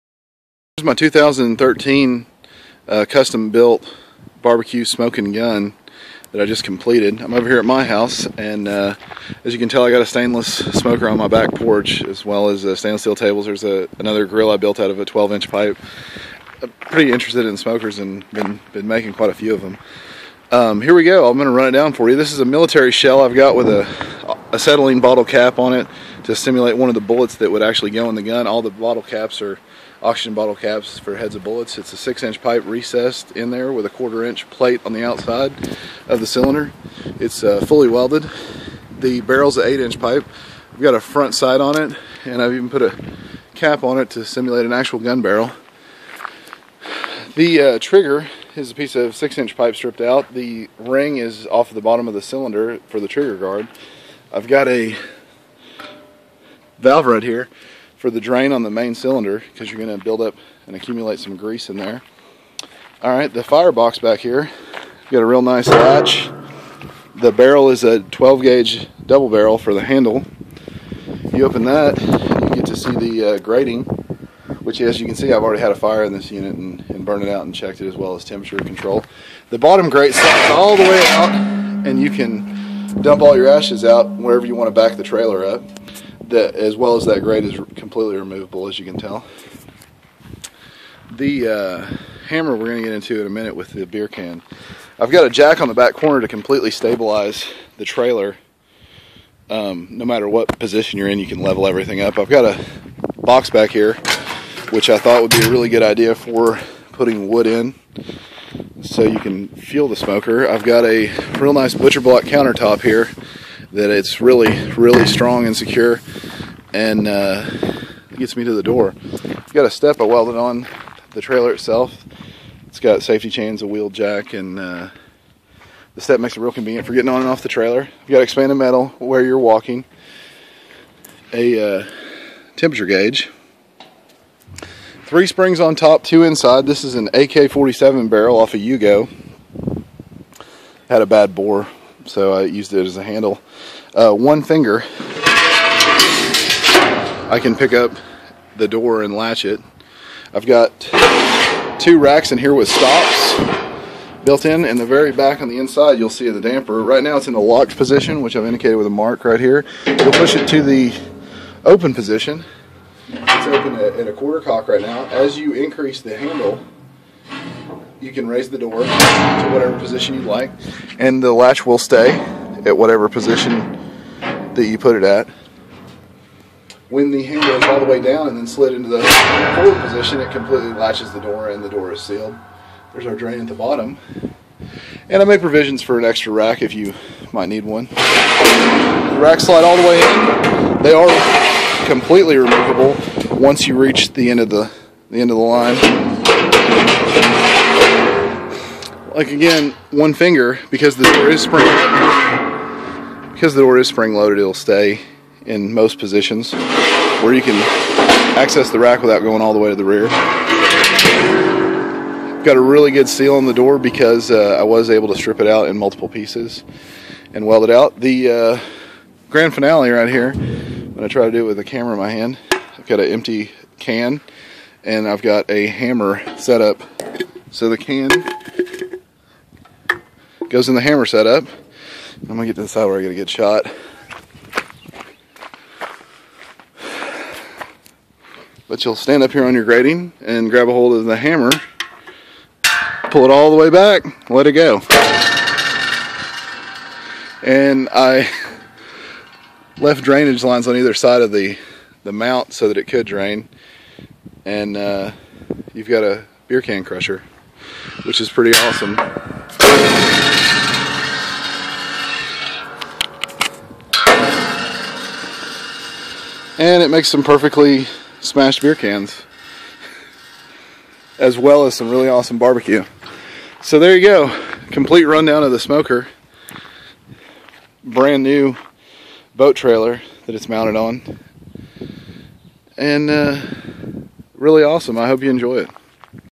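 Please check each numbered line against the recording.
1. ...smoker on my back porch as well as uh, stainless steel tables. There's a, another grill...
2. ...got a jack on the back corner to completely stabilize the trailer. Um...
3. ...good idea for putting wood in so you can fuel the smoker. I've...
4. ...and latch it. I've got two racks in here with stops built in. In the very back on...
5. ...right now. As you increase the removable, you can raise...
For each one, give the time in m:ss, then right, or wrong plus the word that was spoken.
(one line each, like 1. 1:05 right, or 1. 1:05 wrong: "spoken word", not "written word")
1. 0:10 right
2. 1:35 right
3. 1:45 right
4. 2:29 right
5. 2:44 wrong: "handle", not "removable".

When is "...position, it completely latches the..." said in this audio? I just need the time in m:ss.
2:59.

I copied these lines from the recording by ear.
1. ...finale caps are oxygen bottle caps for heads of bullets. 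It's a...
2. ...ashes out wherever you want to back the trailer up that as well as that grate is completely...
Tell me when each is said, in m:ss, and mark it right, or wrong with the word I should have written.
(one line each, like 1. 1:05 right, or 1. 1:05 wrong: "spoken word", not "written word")
1. 0:28 wrong: "bottle", not "finale"
2. 1:23 right.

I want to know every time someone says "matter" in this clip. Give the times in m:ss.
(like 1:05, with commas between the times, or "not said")
1:40.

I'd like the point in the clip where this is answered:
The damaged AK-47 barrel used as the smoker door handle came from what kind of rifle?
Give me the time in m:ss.
2:18.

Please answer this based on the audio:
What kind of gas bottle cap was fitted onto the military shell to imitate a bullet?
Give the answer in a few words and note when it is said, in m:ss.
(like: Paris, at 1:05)
acetylene bottle cap, at 0:24.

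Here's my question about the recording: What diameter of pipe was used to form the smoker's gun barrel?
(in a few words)
8 inch.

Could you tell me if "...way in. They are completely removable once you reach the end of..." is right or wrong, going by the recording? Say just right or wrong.
right.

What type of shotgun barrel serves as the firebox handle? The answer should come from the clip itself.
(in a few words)
12 gauge double barrel.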